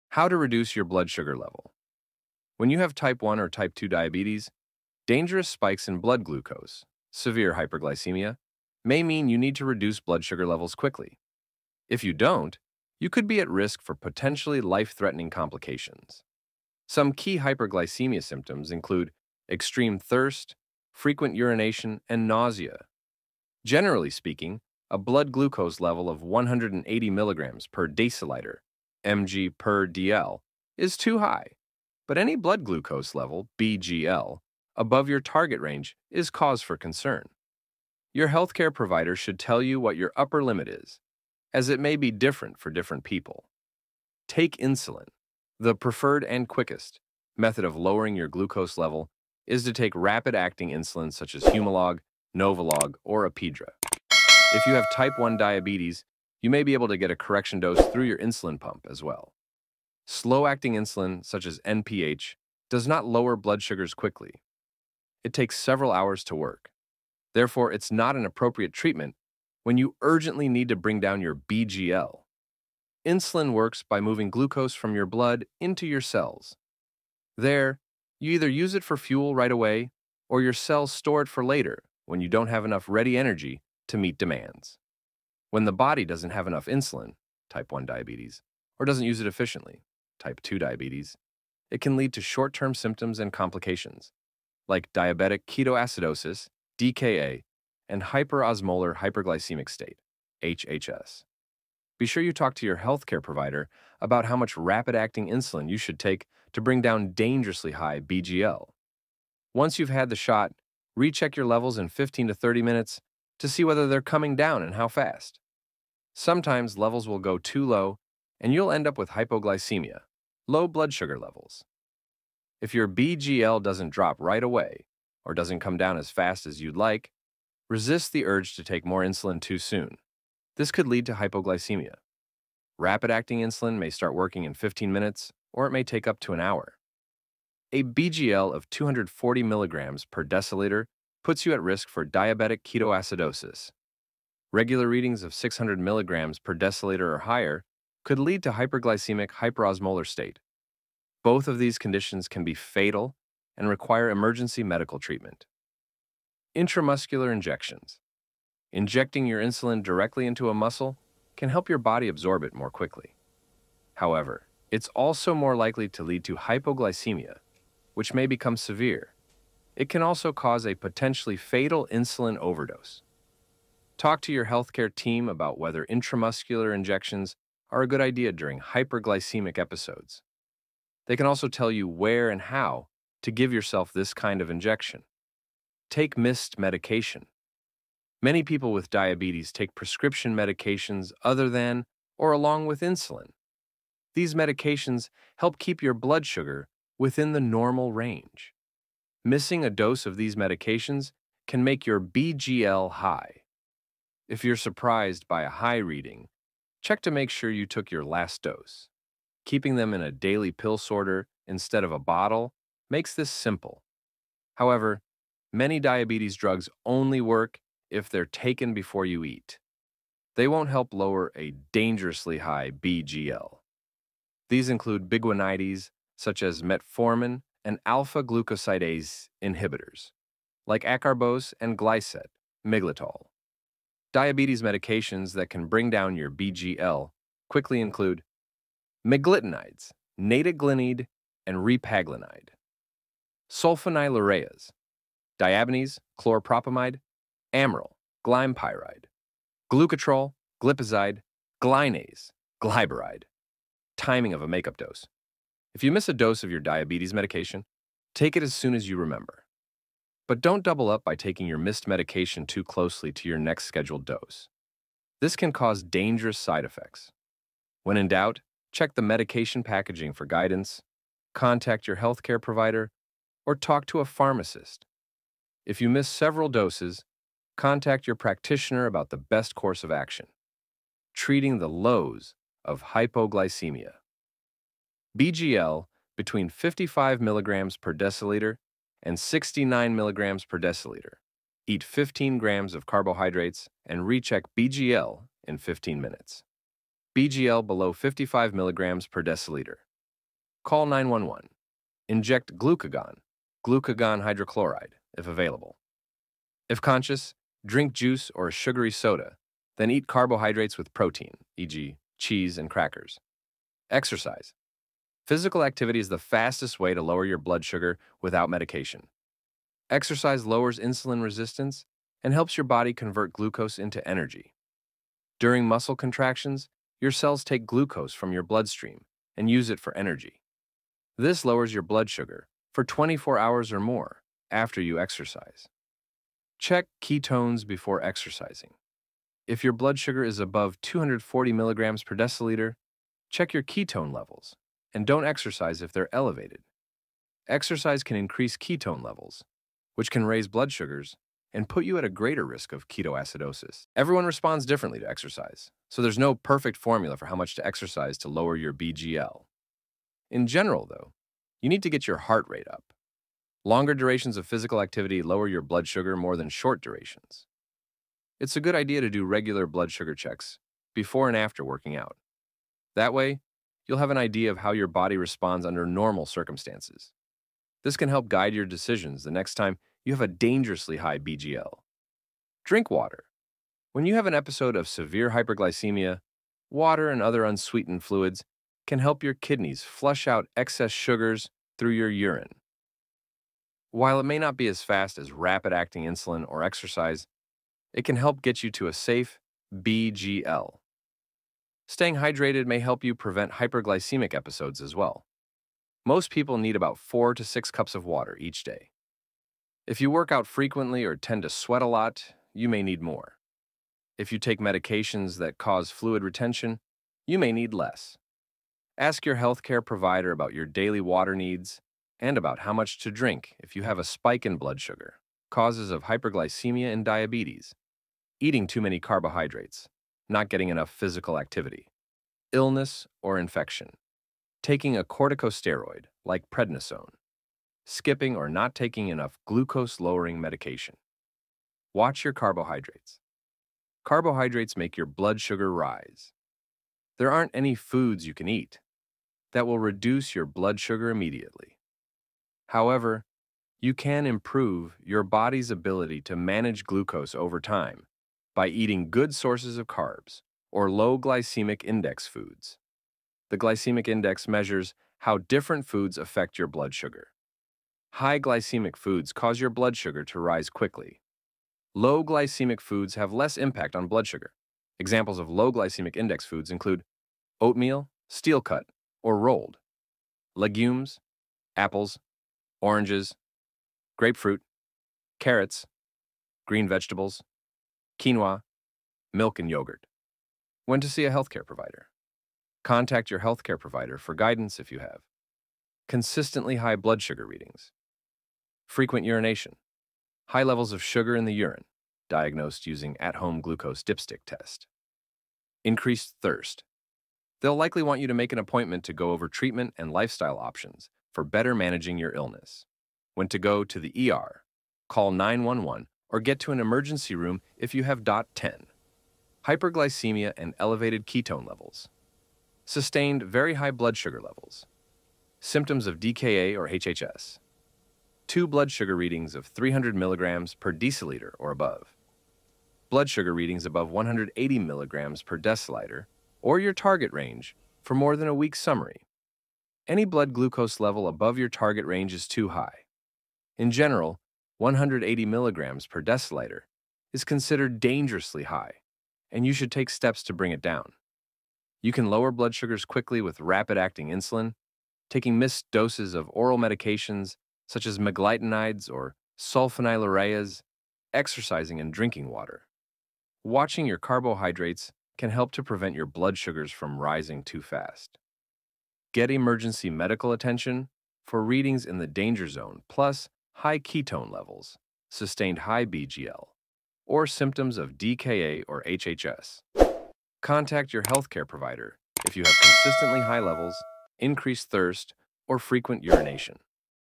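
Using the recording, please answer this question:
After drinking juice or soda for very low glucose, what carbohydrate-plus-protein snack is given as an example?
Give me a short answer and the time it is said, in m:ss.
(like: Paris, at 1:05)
Cheese and crackers, at 5:12.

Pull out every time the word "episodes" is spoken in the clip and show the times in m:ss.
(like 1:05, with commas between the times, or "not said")
2:59, 6:24, 6:44.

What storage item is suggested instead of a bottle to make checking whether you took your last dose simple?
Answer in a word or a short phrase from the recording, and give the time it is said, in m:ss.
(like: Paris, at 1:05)
Daily pill sorter, at 3:30.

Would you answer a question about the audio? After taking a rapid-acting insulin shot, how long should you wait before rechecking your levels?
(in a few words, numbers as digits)
15 to 30 minutes.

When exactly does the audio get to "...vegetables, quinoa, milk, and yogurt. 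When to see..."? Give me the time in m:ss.
8:06.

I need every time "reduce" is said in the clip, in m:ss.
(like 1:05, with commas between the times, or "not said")
0:00, 0:09, 7:29.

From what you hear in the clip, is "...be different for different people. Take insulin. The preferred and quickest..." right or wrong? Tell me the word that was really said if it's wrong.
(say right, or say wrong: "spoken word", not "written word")
right.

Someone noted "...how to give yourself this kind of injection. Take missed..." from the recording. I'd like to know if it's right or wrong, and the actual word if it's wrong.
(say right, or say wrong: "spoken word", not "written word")
right.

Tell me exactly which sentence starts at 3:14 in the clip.
These medications help keep your blood sugar within the normal range.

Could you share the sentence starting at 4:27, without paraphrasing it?
When in doubt, check the medication packaging for guidance, contact your healthcare provider, or talk to a pharmacist.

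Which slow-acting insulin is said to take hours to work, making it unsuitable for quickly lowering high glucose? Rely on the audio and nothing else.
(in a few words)
NPH.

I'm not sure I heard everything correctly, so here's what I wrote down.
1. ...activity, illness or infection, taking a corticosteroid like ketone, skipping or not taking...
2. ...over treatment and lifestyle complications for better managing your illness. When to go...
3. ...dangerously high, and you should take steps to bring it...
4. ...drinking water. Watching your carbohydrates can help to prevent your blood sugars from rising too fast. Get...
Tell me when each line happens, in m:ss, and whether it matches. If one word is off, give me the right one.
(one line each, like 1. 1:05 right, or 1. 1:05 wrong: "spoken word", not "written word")
1. 7:11 wrong: "prednisone", not "ketone"
2. 8:29 wrong: "options", not "complications"
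3. 9:07 right
4. 9:22 right.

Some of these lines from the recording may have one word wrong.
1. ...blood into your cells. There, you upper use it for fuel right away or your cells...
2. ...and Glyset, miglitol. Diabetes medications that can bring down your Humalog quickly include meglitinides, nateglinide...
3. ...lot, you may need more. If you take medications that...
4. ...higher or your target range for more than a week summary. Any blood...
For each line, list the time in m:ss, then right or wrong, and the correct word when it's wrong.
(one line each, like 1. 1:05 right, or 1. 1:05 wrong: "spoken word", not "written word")
1. 1:15 wrong: "either", not "upper"
2. 3:51 wrong: "BGL", not "Humalog"
3. 6:51 right
4. 8:55 wrong: "deciliter", not "higher".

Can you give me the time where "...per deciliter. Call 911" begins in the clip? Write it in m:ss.
4:59.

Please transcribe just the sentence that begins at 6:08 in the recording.
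It's a good idea to do regular blood sugar checks before and after working out.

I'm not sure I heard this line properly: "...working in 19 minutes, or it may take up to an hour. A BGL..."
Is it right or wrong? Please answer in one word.
wrong.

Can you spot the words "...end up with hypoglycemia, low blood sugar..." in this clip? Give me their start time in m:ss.
1:58.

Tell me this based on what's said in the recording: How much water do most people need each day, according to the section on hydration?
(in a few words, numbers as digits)
4 to 6 cups.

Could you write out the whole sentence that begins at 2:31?
Both of these conditions can be fatal and require emergency medical treatment.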